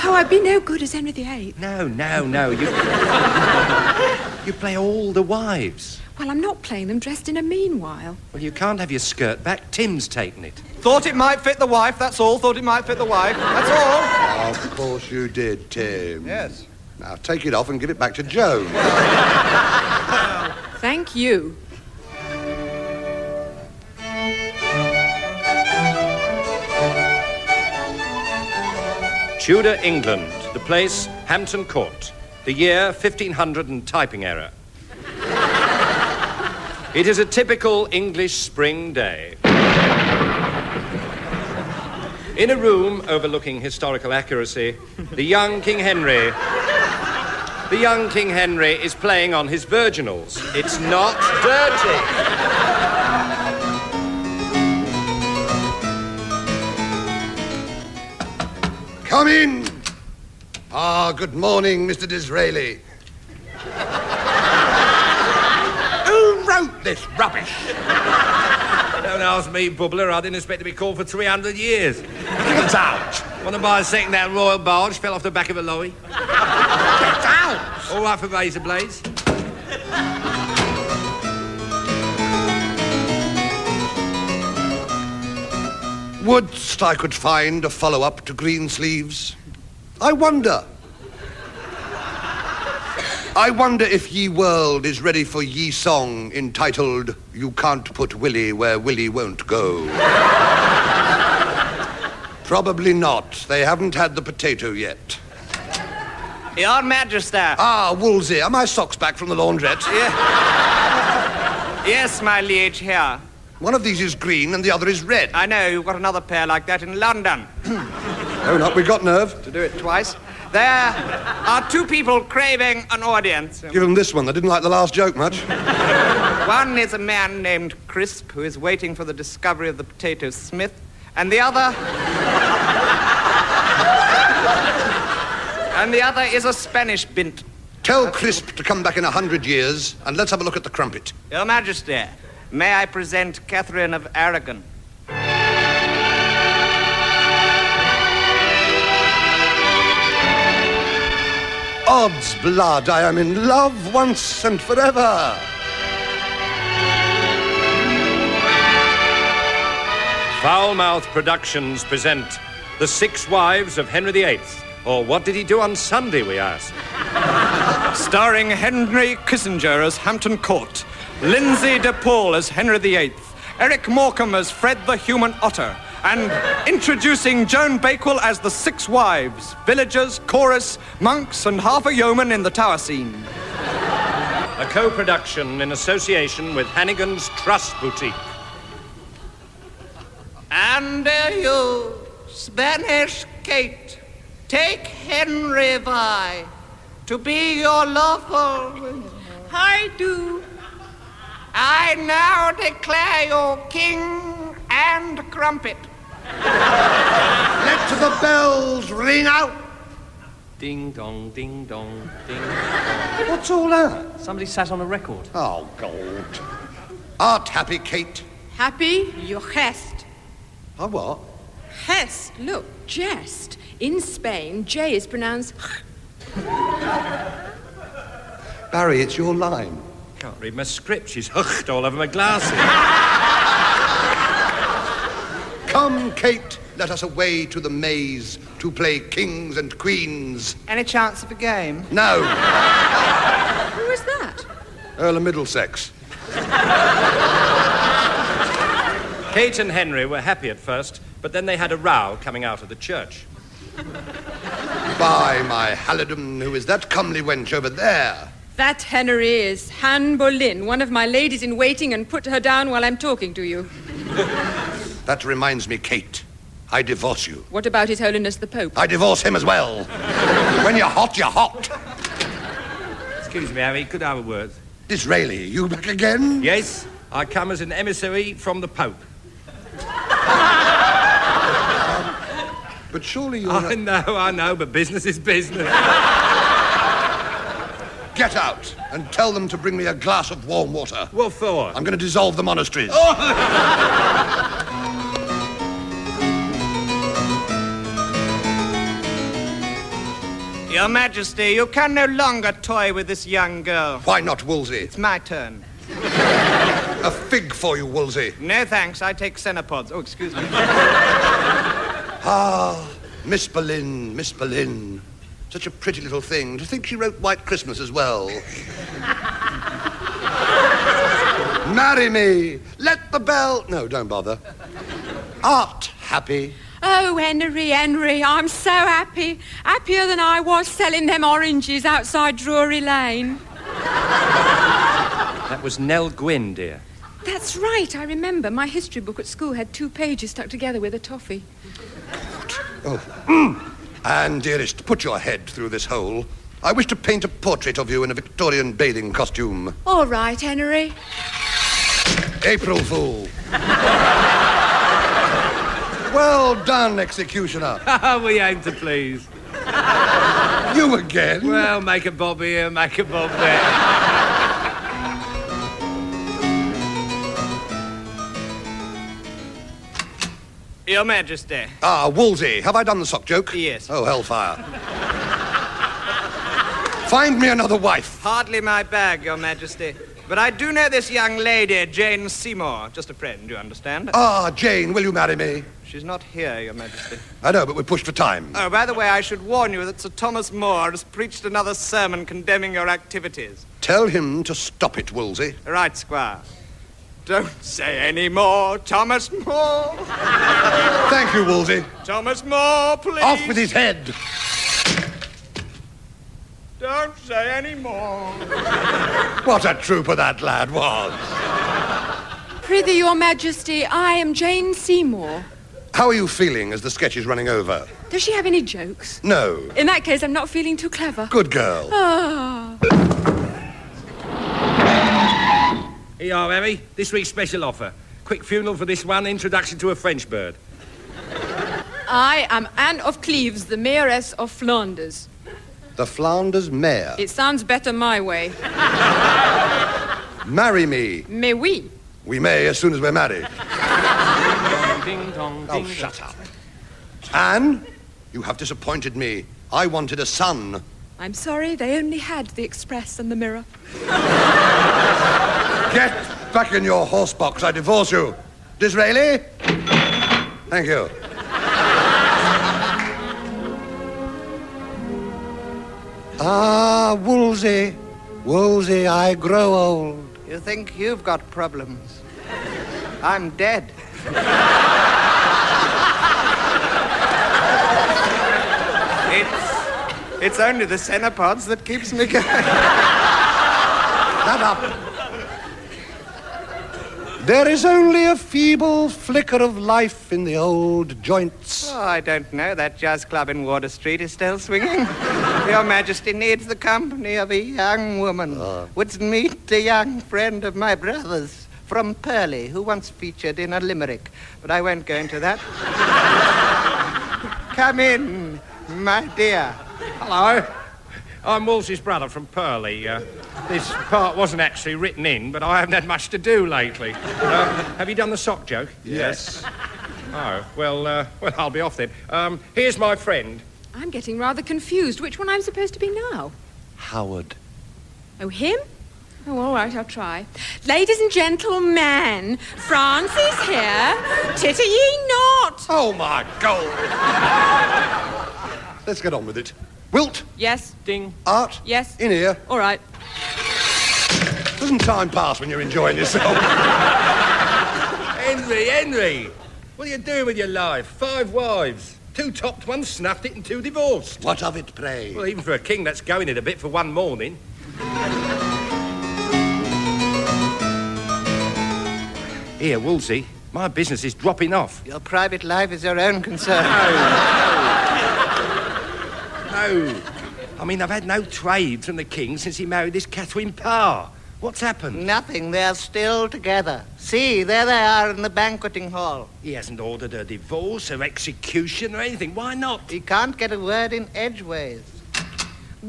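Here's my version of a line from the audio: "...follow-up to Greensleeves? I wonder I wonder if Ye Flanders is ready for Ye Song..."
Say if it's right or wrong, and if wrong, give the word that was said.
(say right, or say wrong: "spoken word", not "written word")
wrong: "World", not "Flanders".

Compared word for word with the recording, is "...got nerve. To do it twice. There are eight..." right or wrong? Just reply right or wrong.
wrong.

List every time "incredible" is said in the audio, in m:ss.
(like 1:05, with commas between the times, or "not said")
not said.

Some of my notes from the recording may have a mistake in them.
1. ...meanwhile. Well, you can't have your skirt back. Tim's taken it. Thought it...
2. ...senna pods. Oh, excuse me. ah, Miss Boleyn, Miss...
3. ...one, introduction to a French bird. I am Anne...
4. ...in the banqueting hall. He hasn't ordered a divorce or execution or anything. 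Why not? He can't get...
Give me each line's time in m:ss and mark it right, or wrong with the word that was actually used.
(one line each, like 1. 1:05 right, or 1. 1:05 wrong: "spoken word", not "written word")
1. 0:07 right
2. 5:09 right
3. 7:09 right
4. 9:38 right.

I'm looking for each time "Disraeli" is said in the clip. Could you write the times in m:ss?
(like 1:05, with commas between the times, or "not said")
1:02, 4:34, 7:38.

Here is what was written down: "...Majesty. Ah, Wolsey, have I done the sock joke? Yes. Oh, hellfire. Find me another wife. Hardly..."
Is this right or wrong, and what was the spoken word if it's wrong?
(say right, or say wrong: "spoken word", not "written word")
right.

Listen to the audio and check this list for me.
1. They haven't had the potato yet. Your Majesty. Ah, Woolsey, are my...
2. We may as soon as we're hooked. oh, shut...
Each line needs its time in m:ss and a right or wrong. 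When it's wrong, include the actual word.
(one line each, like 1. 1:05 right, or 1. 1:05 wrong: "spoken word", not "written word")
1. 1:43 right
2. 7:22 wrong: "married", not "hooked".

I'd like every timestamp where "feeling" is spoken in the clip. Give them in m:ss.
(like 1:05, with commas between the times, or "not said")
6:56, 7:00.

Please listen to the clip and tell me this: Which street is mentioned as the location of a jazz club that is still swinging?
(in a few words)
Water Street.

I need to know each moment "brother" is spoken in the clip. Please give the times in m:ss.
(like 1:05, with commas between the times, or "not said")
8:20, 8:31.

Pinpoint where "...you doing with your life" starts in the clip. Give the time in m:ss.
9:10.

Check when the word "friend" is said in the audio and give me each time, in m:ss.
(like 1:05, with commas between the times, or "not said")
6:23, 8:20, 8:43.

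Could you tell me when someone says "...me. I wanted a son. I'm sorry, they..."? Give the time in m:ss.
7:29.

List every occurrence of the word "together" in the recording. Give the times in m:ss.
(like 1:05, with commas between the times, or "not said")
5:40, 9:36.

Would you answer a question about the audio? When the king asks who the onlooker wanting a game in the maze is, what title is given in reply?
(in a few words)
Earl of Middlesex.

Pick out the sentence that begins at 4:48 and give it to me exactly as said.
Get out and tell them to bring me a glass of warm water.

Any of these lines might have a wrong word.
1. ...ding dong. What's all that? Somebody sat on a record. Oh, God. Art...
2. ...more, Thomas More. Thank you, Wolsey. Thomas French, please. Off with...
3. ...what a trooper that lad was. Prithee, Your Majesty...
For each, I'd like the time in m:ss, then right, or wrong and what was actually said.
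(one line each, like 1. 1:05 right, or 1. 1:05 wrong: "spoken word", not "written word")
1. 3:32 right
2. 6:38 wrong: "More", not "French"
3. 6:49 right.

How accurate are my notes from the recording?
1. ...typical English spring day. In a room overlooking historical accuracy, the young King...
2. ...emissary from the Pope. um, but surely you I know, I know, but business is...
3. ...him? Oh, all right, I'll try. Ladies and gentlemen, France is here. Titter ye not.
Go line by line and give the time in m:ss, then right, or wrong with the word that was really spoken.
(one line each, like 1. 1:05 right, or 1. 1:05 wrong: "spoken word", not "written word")
1. 0:37 right
2. 4:37 right
3. 8:48 right.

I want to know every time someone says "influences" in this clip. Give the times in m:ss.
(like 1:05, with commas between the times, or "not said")
not said.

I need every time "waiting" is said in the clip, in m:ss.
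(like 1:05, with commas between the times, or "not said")
2:08, 4:21.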